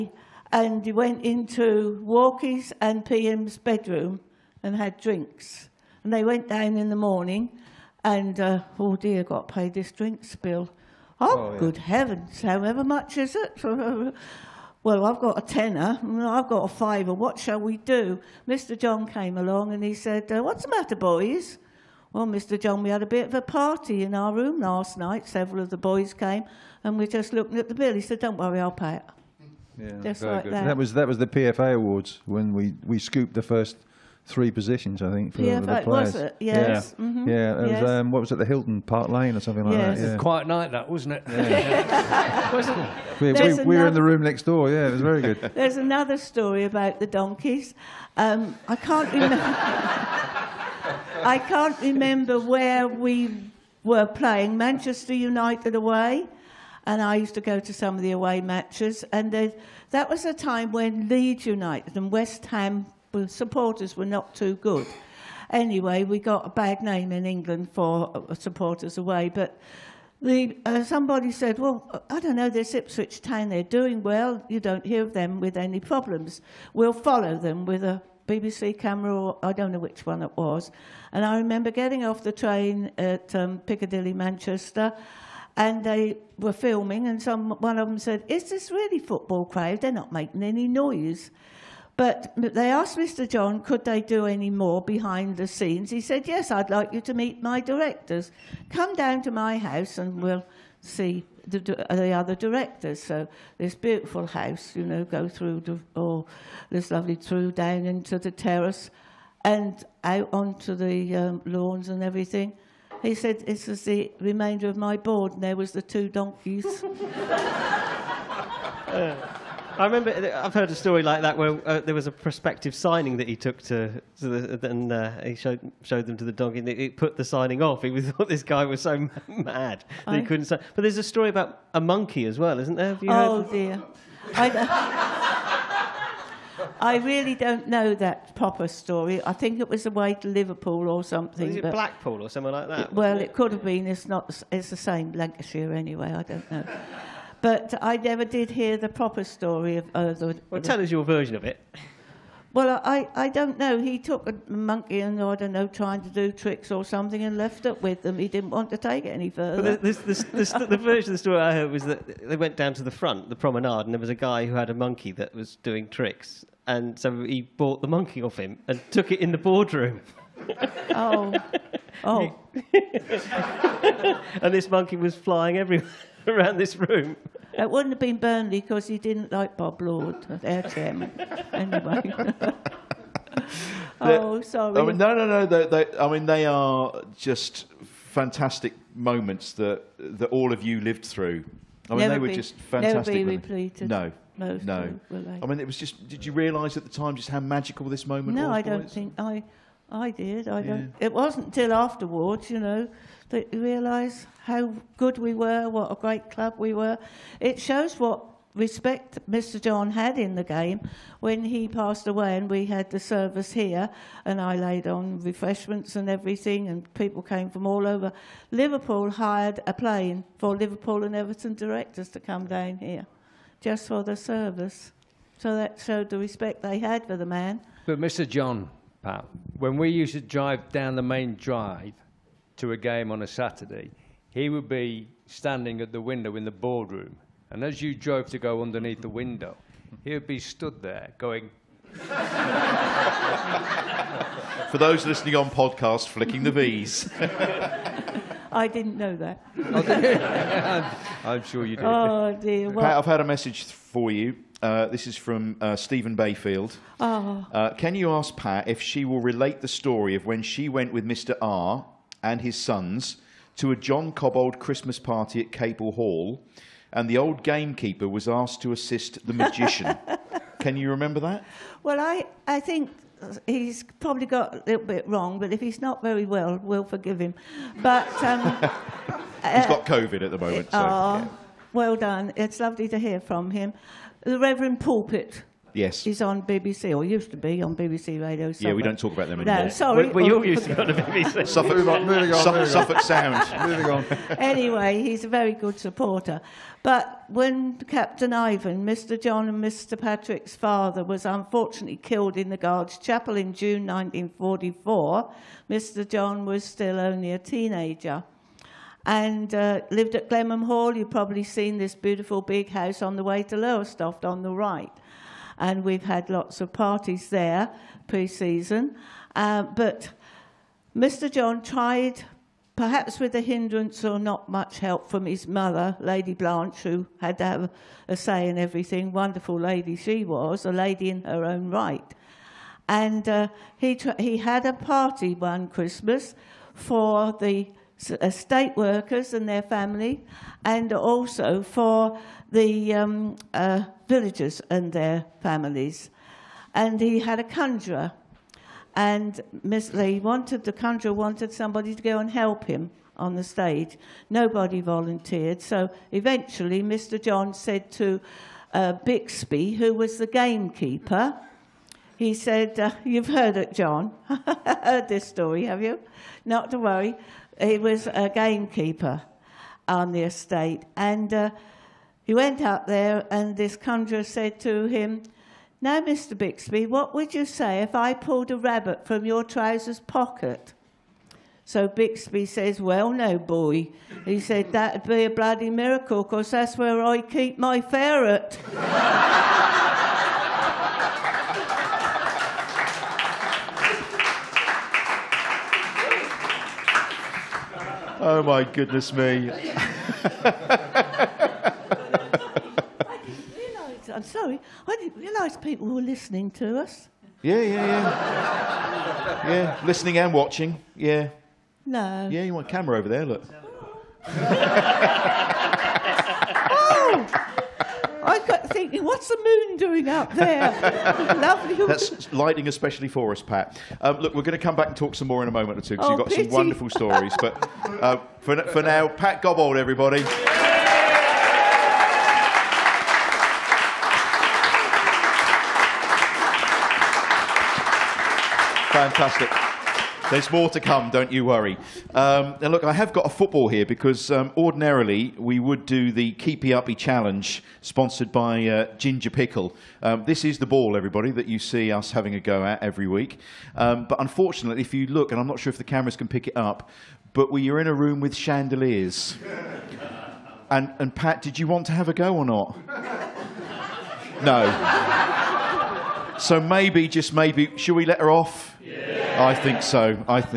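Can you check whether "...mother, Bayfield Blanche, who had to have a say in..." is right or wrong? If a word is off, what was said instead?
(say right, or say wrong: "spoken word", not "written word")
wrong: "Lady", not "Bayfield".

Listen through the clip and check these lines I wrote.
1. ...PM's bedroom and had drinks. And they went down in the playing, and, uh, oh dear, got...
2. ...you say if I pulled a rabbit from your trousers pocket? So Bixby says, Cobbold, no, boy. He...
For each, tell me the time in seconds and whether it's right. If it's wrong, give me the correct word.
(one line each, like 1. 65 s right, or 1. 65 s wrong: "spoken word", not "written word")
1. 3 s wrong: "morning", not "playing"
2. 377 s wrong: "Well", not "Cobbold".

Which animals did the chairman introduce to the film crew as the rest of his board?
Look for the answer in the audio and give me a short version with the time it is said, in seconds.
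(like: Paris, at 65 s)
two donkeys, at 115 s.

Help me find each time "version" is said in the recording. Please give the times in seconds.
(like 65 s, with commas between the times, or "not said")
151 s, 160 s.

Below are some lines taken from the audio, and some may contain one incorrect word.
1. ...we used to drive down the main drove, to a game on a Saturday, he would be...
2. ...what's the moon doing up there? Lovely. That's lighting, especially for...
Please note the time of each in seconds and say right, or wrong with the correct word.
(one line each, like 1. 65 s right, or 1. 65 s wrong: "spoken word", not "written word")
1. 229 s wrong: "drive", not "drove"
2. 419 s right.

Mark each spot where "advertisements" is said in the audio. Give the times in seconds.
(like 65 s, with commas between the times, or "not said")
not said.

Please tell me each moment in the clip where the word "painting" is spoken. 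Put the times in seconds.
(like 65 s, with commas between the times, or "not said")
not said.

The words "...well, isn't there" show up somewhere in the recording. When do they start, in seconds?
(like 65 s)
132 s.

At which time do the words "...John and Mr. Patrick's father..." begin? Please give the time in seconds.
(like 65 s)
299 s.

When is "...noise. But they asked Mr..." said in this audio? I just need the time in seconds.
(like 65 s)
90 s.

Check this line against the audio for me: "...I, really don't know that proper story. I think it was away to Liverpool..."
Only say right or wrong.
right.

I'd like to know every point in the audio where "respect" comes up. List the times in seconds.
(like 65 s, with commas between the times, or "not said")
208 s, 226 s.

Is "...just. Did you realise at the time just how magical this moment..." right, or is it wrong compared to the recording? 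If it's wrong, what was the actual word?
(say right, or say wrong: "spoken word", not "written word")
right.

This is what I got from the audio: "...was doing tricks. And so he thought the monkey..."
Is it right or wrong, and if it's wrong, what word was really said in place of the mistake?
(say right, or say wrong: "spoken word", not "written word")
wrong: "bought", not "thought".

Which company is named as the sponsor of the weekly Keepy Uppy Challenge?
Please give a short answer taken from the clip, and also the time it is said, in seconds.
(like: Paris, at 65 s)
Ginger Pickle, at 448 s.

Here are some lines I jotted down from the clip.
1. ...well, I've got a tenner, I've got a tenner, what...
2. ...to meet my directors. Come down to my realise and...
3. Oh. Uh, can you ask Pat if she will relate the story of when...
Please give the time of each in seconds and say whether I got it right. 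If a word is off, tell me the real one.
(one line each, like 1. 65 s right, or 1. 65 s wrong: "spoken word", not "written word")
1. 14 s wrong: "fiver", not "tenner"
2. 97 s wrong: "house", not "realise"
3. 256 s right.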